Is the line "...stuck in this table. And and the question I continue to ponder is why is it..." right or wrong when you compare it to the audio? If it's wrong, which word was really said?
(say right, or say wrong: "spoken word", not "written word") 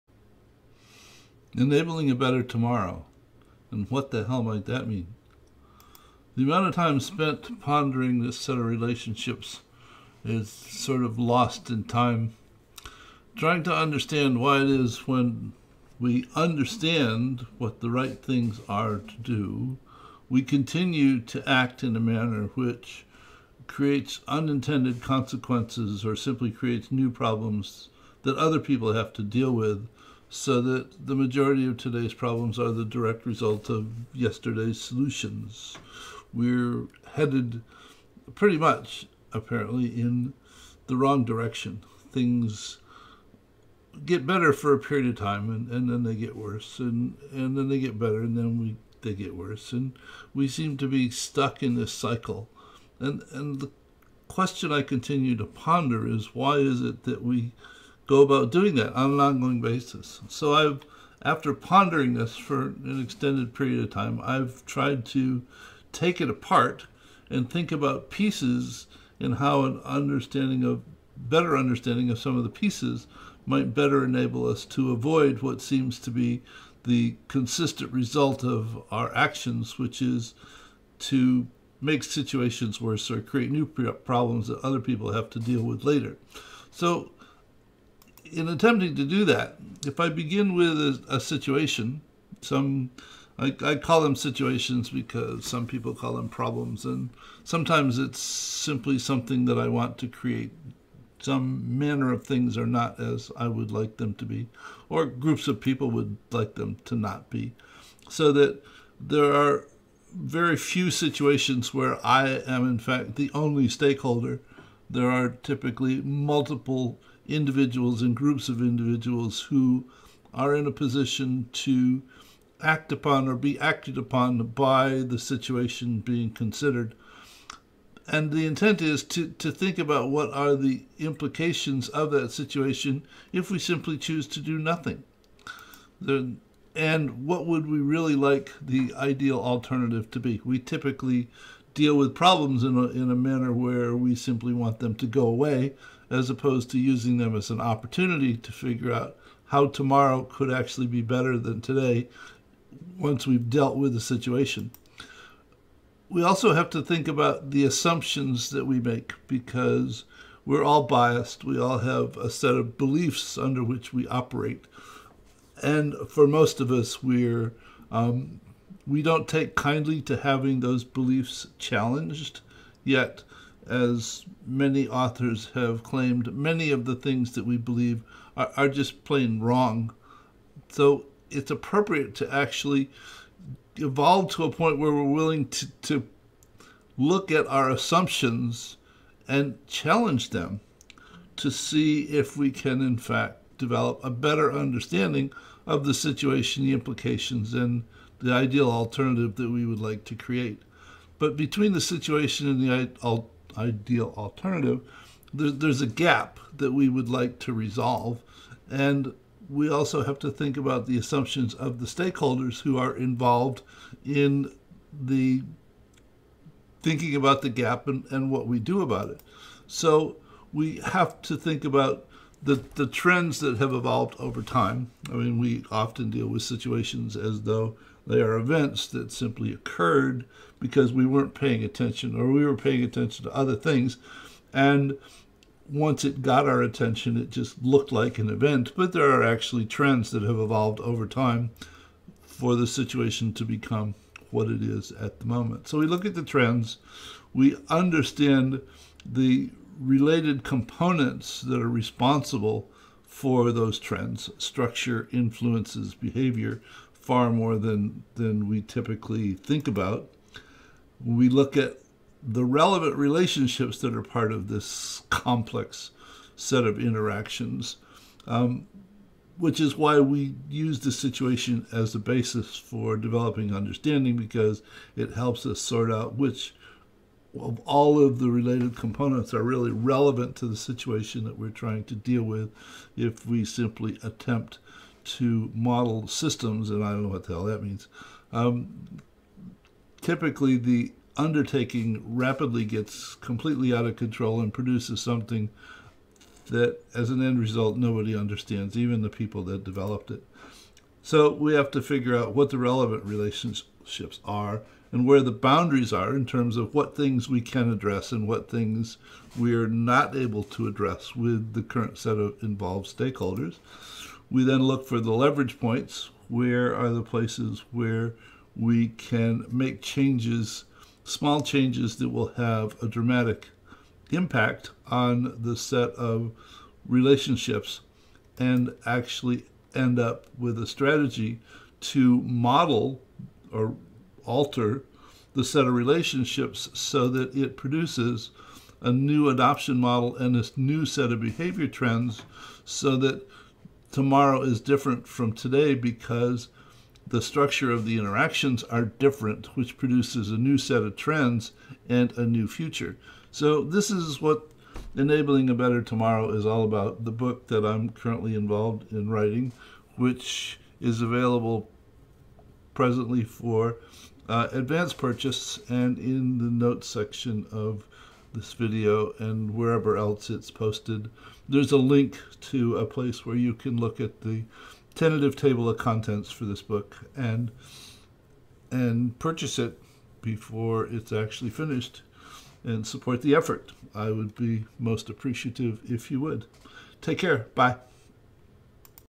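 wrong: "cycle", not "table".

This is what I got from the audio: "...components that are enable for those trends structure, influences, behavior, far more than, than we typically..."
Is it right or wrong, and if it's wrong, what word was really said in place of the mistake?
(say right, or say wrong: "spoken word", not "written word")
wrong: "responsible", not "enable".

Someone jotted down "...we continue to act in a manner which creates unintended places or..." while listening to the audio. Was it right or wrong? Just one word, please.
wrong.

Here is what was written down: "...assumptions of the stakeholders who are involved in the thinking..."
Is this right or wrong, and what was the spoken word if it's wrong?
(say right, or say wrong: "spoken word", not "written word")
right.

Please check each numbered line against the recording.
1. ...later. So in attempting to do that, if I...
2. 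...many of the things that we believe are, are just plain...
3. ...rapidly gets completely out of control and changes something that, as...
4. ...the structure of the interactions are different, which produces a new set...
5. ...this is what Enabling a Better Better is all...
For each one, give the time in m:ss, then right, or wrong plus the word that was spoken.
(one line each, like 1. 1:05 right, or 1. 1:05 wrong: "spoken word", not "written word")
1. 1:25 right
2. 2:56 right
3. 4:52 wrong: "produces", not "changes"
4. 5:47 right
5. 5:53 wrong: "Tomorrow", not "Better".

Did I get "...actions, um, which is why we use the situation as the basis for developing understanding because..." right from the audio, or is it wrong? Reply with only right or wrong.
wrong.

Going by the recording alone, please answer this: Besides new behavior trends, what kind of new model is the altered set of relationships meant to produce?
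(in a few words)
adoption model.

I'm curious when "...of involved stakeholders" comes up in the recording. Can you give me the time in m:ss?
5:12.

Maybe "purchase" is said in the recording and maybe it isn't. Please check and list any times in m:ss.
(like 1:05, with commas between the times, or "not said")
6:04, 6:19.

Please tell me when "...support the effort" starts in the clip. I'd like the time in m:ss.
6:22.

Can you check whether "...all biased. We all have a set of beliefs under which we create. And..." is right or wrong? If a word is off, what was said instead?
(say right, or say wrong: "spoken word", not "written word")
wrong: "operate", not "create".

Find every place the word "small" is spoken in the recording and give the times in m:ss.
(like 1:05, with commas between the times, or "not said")
5:21.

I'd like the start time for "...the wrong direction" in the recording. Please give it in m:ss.
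0:40.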